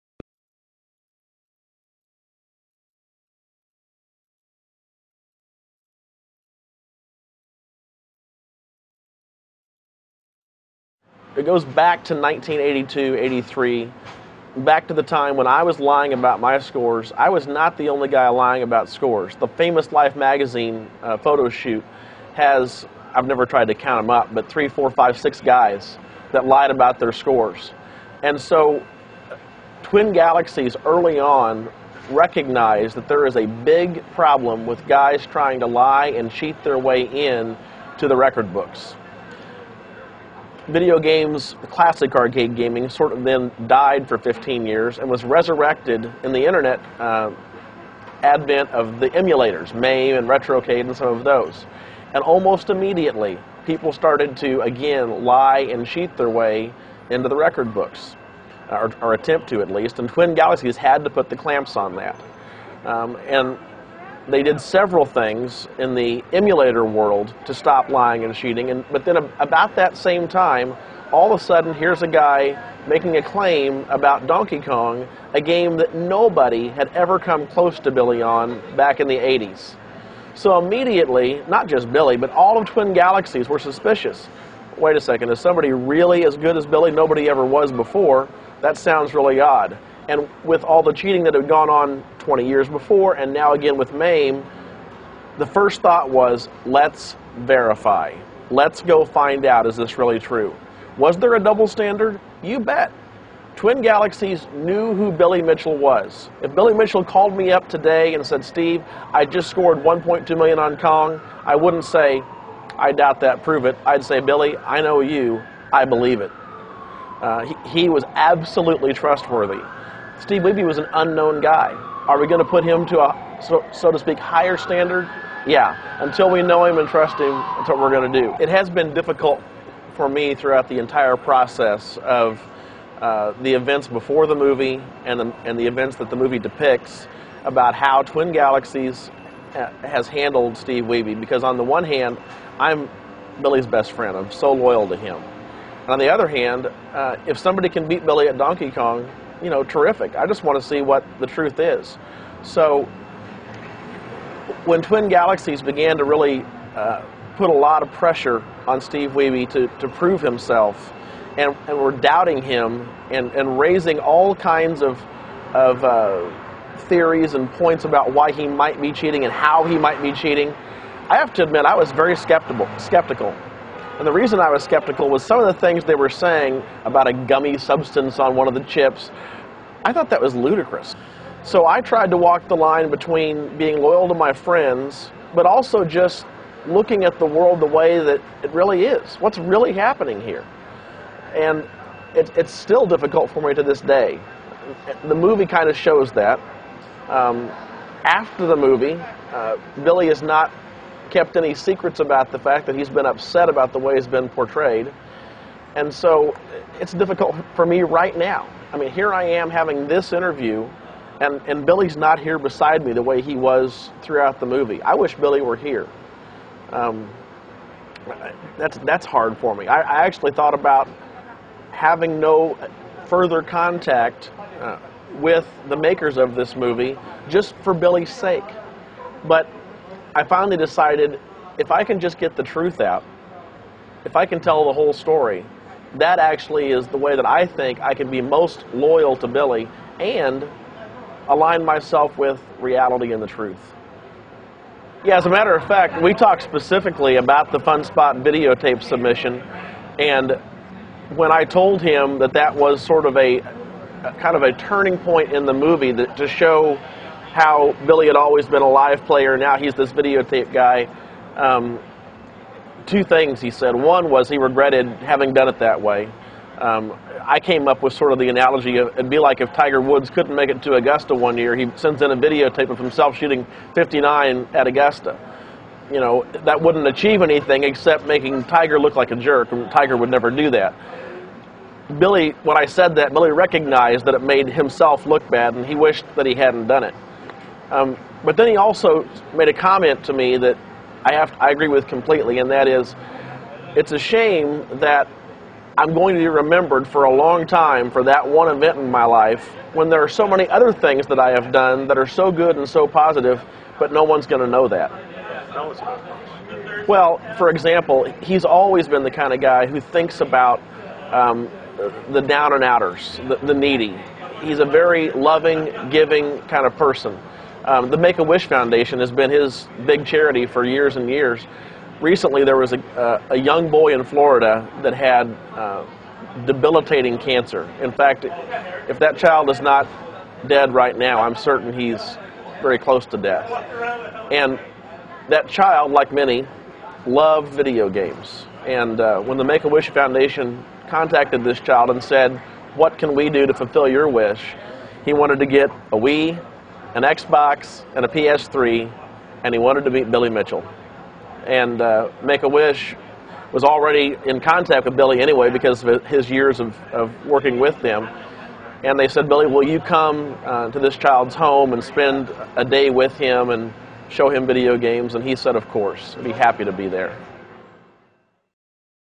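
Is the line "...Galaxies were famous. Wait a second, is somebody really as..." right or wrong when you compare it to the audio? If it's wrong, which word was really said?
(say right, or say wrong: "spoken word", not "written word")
wrong: "suspicious", not "famous".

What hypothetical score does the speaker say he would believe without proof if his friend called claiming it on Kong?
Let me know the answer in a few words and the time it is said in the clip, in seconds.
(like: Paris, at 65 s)
1.2 million, at 109 s.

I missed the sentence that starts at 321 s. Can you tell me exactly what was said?
Recently, there was a, uh, a young boy in Florida that had uh, debilitating cancer.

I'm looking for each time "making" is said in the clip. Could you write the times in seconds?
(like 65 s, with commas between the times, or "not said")
72 s, 278 s.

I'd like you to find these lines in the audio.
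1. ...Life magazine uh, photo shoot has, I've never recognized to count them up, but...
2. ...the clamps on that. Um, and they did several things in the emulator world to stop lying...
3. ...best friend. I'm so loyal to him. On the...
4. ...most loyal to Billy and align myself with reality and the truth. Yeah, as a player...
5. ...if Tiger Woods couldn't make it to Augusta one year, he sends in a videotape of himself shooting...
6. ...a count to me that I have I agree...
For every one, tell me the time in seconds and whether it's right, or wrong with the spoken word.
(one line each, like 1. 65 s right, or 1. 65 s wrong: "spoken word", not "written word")
1. 19 s wrong: "tried", not "recognized"
2. 61 s right
3. 143 s right
4. 238 s wrong: "matter", not "player"
5. 269 s right
6. 289 s wrong: "comment", not "count".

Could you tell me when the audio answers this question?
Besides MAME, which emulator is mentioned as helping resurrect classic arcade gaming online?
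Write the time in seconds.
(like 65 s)
50 s.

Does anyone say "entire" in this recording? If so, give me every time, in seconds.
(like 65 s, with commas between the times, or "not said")
130 s.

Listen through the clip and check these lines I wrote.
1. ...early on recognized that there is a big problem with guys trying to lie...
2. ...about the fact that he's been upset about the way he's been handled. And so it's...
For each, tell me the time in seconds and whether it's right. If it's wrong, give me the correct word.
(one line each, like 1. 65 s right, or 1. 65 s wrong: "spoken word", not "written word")
1. 30 s right
2. 201 s wrong: "portrayed", not "handled".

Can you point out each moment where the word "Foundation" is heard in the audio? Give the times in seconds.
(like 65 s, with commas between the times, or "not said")
318 s, 339 s.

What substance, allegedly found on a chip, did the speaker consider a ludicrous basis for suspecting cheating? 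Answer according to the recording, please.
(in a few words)
gummy substance.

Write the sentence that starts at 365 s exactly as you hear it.
And he said, Of course, I'd be happy to be there.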